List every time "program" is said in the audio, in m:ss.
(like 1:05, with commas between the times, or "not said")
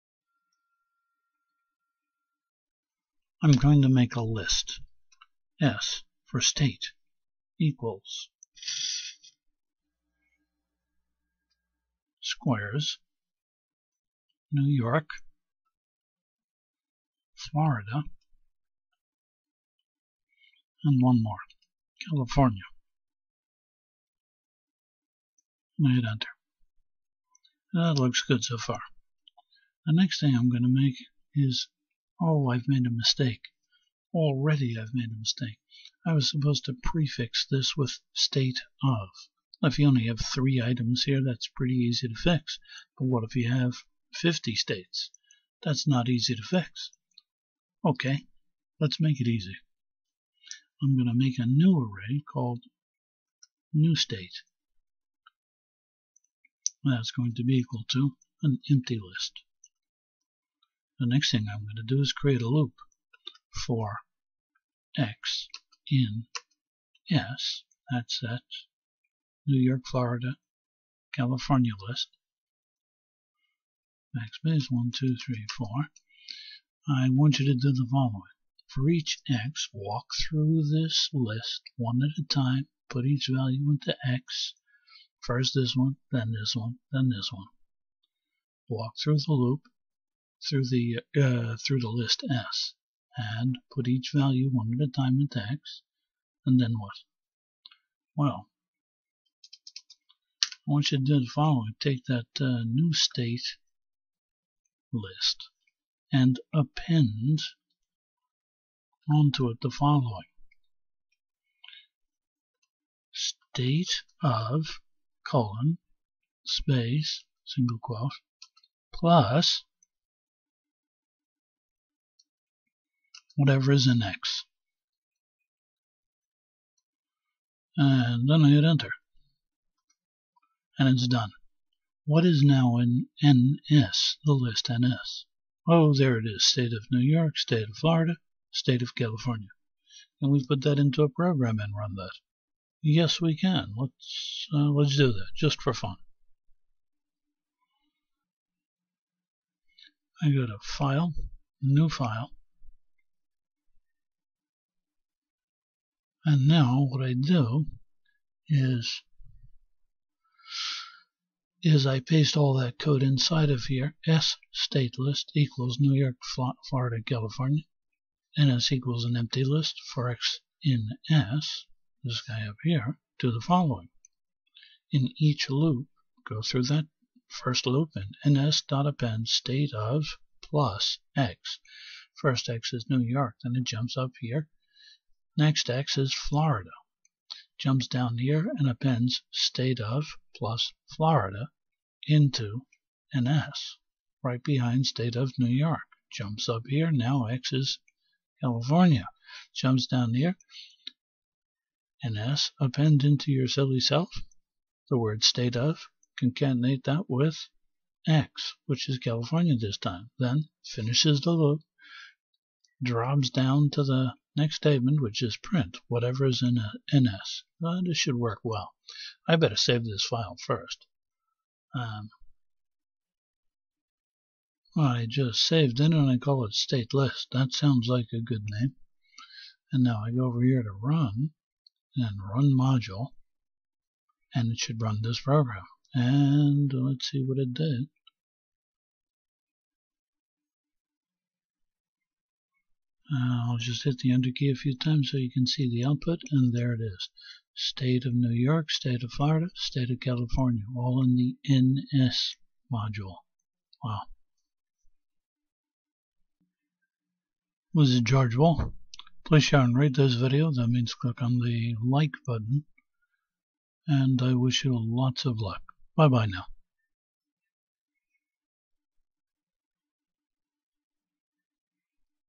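2:21, 3:55.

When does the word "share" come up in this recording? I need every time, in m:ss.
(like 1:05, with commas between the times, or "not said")
4:19.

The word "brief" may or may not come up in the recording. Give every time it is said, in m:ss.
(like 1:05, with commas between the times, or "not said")
not said.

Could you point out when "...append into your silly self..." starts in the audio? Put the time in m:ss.
3:22.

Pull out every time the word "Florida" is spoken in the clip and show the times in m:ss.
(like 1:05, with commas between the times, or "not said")
0:17, 1:09, 2:17, 2:46, 3:06, 3:10, 4:09.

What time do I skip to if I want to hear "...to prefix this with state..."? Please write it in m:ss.
0:36.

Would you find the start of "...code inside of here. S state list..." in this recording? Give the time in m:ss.
2:42.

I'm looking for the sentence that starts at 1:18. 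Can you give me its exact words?
For each x, walk through this list one at a time, put each value into x.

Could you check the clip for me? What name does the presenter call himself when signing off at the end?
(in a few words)
George Boole.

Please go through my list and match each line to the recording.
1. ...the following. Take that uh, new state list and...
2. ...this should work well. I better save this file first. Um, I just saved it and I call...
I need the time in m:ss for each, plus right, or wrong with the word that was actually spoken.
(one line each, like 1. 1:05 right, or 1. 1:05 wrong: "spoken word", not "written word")
1. 1:41 right
2. 3:37 right.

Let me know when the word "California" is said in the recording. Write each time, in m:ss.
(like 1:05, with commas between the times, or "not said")
0:22, 1:11, 2:18, 2:47, 3:18, 3:28, 4:09.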